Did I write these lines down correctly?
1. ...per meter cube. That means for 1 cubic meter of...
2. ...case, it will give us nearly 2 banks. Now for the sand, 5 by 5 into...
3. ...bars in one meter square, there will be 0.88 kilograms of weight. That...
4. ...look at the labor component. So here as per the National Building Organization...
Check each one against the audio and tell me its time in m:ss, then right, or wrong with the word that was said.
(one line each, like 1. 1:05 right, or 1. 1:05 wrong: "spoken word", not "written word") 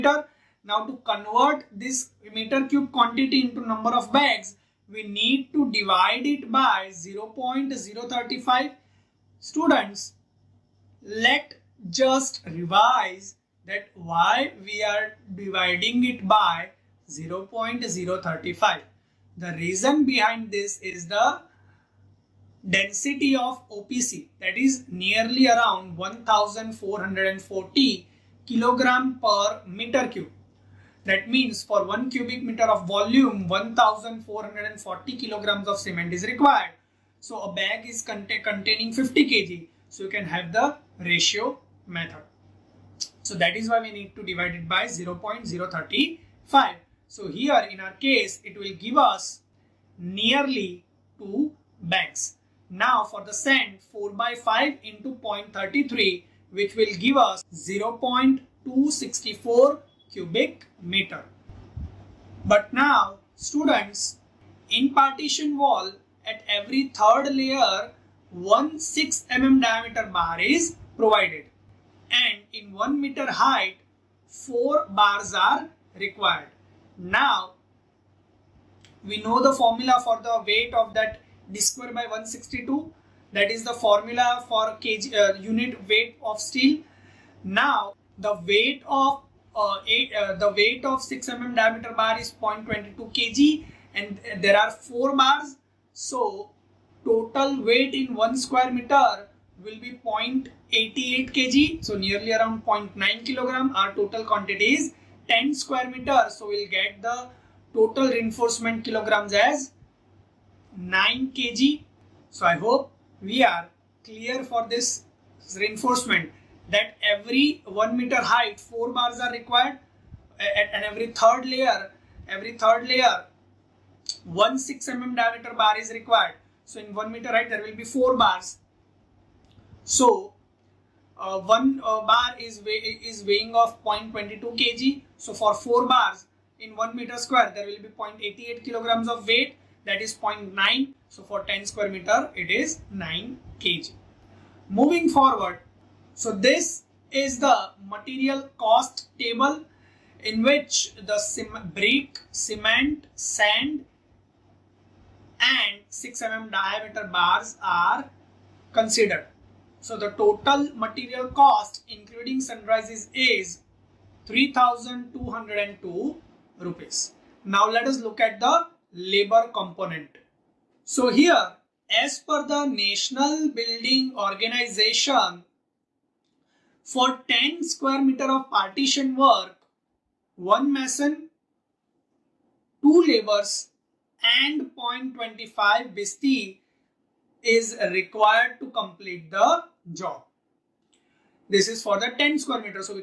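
1. 0:29 right
2. 0:47 wrong: "4", not "5"
3. 2:15 right
4. 2:47 right.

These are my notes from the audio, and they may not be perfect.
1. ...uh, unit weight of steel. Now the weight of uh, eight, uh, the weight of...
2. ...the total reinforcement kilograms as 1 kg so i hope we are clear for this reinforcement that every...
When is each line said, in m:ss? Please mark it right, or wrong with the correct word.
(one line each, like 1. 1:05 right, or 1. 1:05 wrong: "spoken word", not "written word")
1. 1:25 right
2. 1:47 wrong: "9", not "1".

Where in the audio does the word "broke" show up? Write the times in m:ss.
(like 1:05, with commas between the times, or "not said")
not said.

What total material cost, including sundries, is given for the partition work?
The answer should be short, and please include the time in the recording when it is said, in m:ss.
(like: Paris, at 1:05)
3202 rupees, at 2:44.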